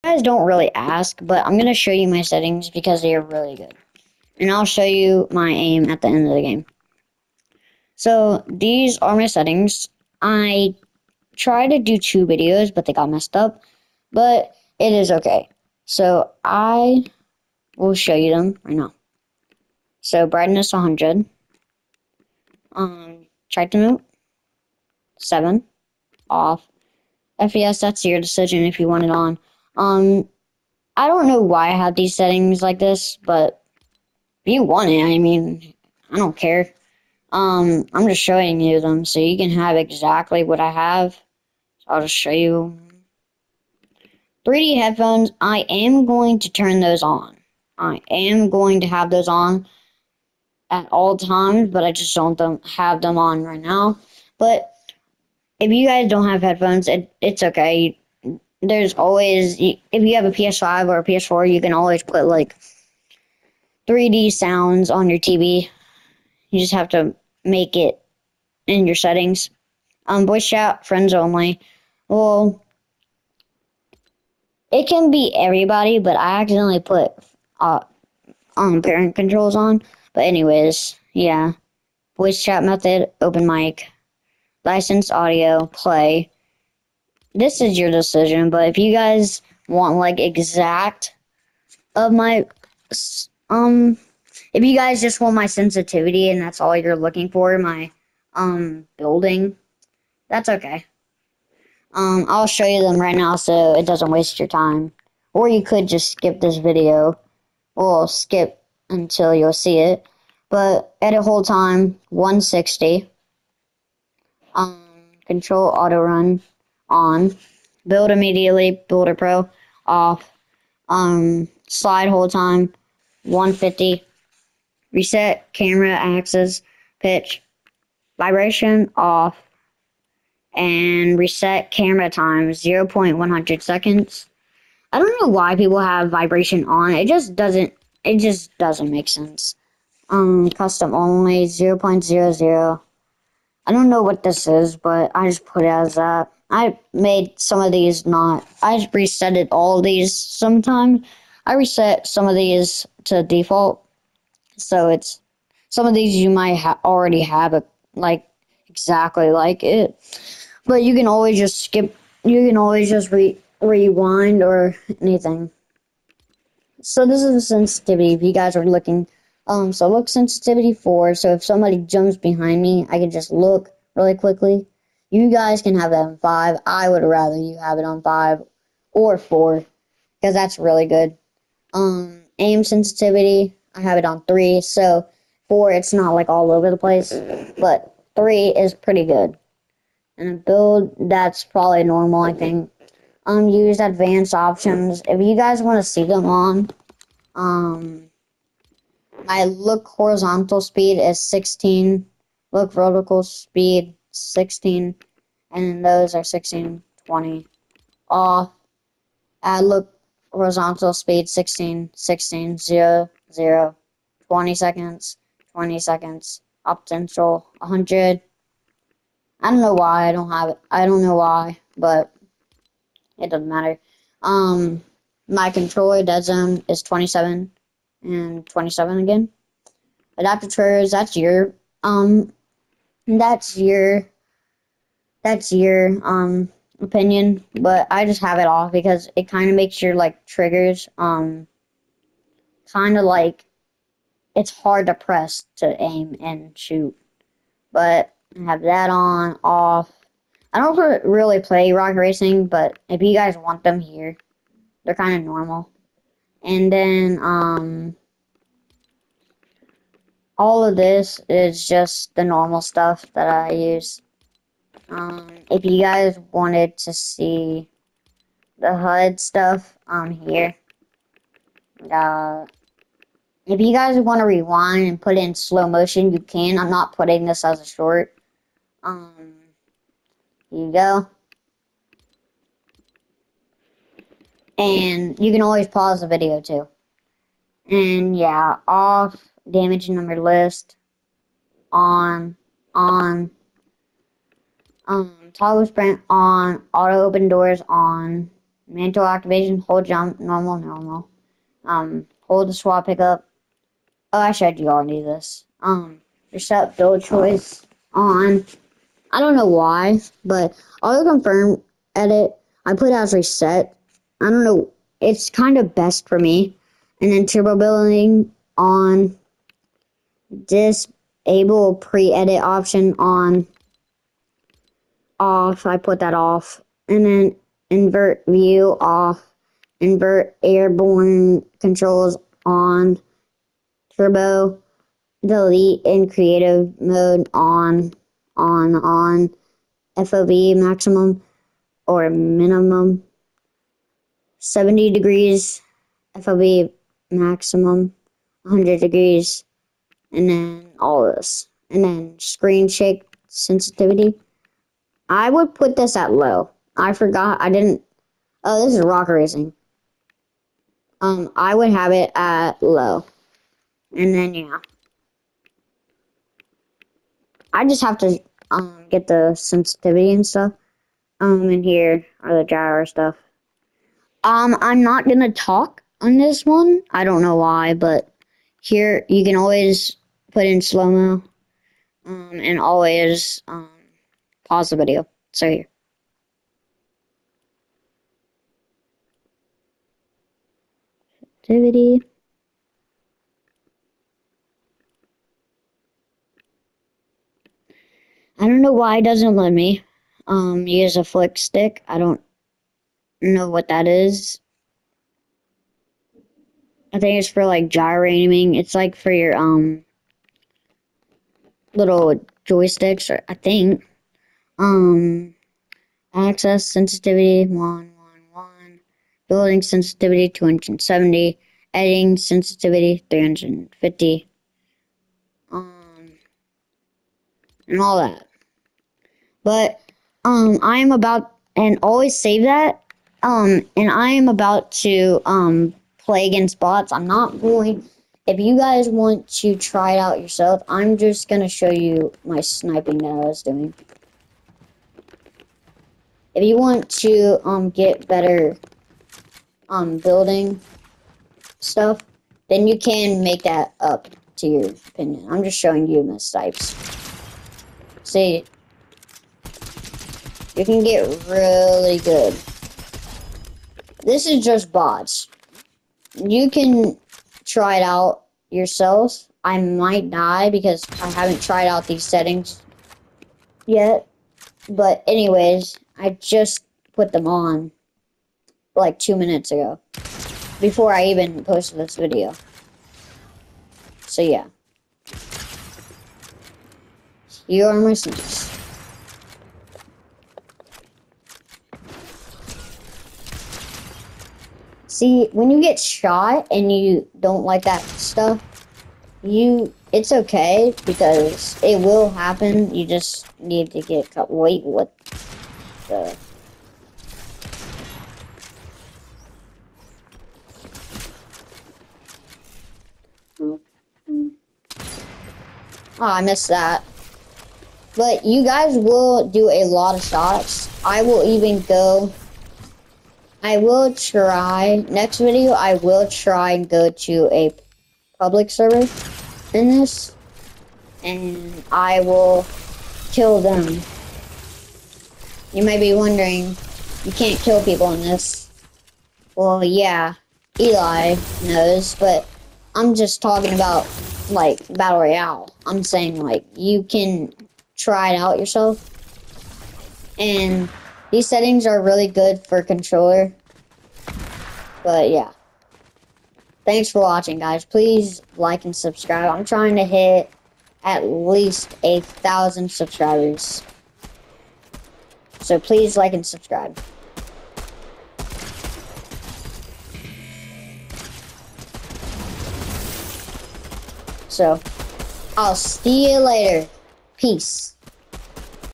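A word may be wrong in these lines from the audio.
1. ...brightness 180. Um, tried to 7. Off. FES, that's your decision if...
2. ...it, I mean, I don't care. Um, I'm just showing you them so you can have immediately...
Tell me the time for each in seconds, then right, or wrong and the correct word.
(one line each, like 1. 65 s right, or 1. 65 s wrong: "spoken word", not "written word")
1. 20 s wrong: "100", not "180"
2. 34 s wrong: "exactly", not "immediately".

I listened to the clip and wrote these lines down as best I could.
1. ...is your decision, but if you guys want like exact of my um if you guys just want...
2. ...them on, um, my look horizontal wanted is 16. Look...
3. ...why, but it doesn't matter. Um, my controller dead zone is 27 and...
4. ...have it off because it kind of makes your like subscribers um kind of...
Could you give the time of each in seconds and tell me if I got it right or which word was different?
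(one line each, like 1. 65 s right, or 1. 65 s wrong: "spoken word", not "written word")
1. 87 s right
2. 196 s wrong: "speed", not "wanted"
3. 221 s right
4. 238 s wrong: "triggers", not "subscribers".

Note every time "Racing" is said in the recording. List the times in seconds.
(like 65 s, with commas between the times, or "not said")
251 s, 359 s.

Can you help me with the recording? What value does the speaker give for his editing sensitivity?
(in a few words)
350.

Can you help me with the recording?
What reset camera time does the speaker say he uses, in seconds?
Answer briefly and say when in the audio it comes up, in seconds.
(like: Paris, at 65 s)
0.100 seconds, at 132 s.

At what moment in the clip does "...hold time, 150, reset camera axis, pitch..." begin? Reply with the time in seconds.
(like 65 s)
122 s.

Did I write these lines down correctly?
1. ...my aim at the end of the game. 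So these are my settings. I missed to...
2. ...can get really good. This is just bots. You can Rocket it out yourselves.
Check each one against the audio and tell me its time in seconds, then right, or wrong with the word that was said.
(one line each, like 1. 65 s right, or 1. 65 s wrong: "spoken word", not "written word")
1. 5 s wrong: "tried", not "missed"
2. 460 s wrong: "Try", not "Rocket".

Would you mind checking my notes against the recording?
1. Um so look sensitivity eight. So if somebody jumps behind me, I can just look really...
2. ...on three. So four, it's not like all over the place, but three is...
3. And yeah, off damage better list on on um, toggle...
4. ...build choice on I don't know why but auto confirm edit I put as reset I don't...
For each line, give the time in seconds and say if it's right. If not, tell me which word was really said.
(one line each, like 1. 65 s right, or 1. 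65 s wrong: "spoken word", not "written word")
1. 169 s wrong: "four", not "eight"
2. 184 s right
3. 287 s wrong: "number", not "better"
4. 306 s right.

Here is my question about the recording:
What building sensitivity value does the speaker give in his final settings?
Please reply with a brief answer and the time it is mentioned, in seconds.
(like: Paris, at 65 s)
270, at 420 s.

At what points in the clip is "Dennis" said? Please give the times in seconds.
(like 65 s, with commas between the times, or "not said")
not said.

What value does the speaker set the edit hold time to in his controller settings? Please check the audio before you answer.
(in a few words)
160.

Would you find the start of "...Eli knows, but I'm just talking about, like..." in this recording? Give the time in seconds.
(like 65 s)
540 s.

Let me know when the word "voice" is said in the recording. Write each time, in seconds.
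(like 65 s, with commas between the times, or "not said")
70 s, 82 s.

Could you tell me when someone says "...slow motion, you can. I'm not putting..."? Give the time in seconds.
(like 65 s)
275 s.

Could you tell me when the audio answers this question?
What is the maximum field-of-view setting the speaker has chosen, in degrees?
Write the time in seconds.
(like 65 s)
348 s.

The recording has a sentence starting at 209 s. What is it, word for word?
Add loop horizontal speed 16, 16, 0, 0, 20 seconds, 20 seconds, up potential 100.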